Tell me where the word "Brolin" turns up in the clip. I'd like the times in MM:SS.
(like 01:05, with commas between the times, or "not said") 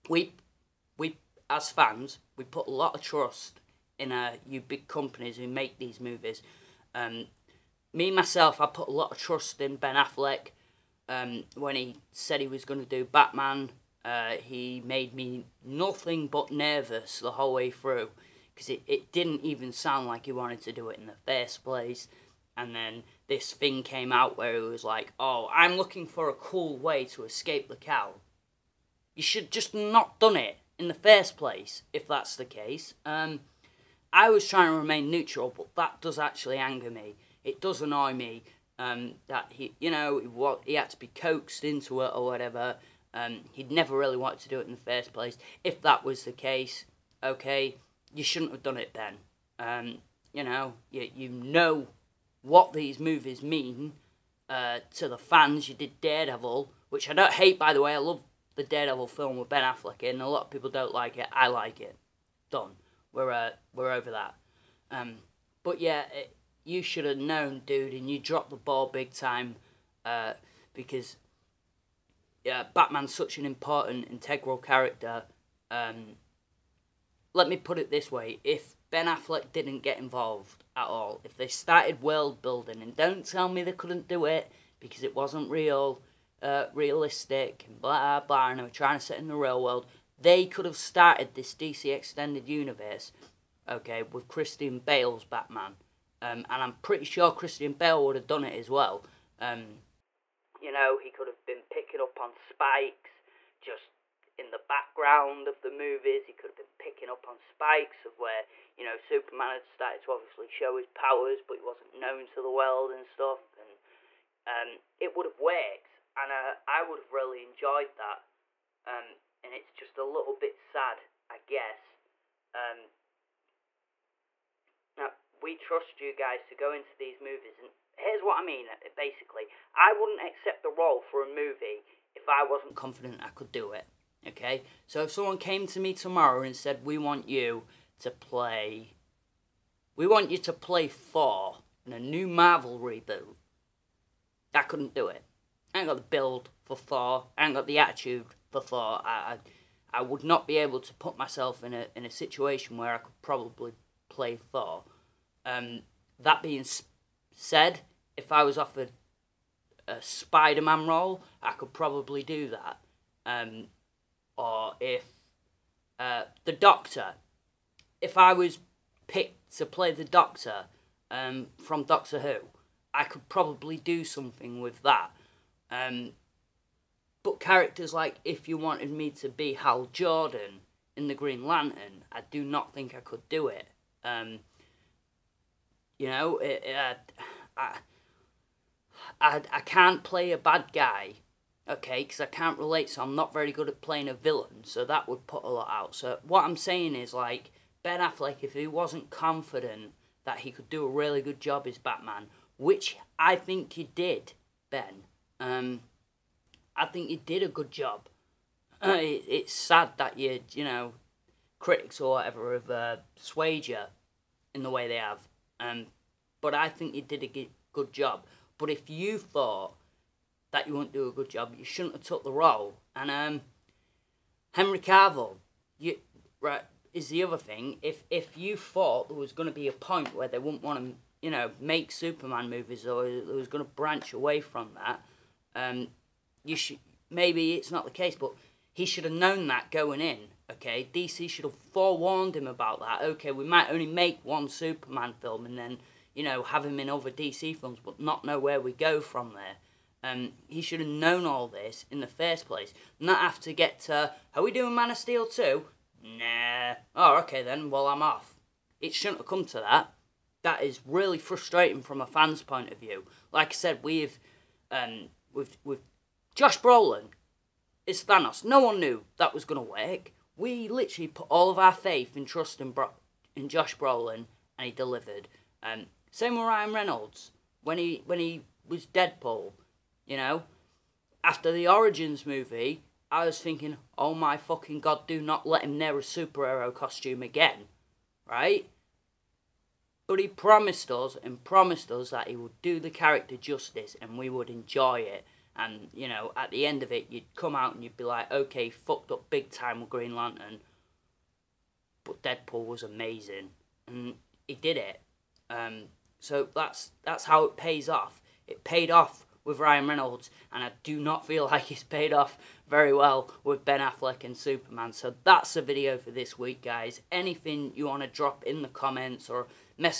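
04:26, 04:33.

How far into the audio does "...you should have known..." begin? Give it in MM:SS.
01:06.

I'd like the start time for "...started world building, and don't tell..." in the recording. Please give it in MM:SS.
01:21.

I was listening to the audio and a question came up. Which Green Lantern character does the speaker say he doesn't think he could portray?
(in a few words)
Hal Jordan.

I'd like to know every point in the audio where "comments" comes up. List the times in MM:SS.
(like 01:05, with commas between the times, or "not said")
05:18.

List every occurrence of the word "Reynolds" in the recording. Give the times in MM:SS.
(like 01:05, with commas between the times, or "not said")
04:36, 05:09.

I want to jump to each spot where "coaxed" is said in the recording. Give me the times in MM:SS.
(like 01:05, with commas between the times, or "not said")
00:41.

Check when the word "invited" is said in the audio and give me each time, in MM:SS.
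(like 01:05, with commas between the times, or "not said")
not said.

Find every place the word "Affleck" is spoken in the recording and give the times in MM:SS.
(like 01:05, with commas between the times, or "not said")
00:09, 00:59, 01:19, 03:18, 05:13.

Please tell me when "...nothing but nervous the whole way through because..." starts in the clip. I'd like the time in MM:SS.
00:15.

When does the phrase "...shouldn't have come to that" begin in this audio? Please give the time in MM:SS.
04:18.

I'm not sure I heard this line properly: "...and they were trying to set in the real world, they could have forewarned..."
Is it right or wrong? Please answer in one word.
wrong.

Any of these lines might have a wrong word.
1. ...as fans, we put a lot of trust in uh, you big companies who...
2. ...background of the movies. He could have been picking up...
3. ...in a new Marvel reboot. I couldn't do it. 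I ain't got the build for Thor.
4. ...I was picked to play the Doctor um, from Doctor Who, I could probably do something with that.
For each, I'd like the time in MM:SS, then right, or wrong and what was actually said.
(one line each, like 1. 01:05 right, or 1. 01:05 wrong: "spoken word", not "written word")
1. 00:01 right
2. 01:44 right
3. 02:21 right
4. 02:48 right.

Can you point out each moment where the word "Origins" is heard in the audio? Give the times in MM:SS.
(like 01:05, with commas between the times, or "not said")
04:41.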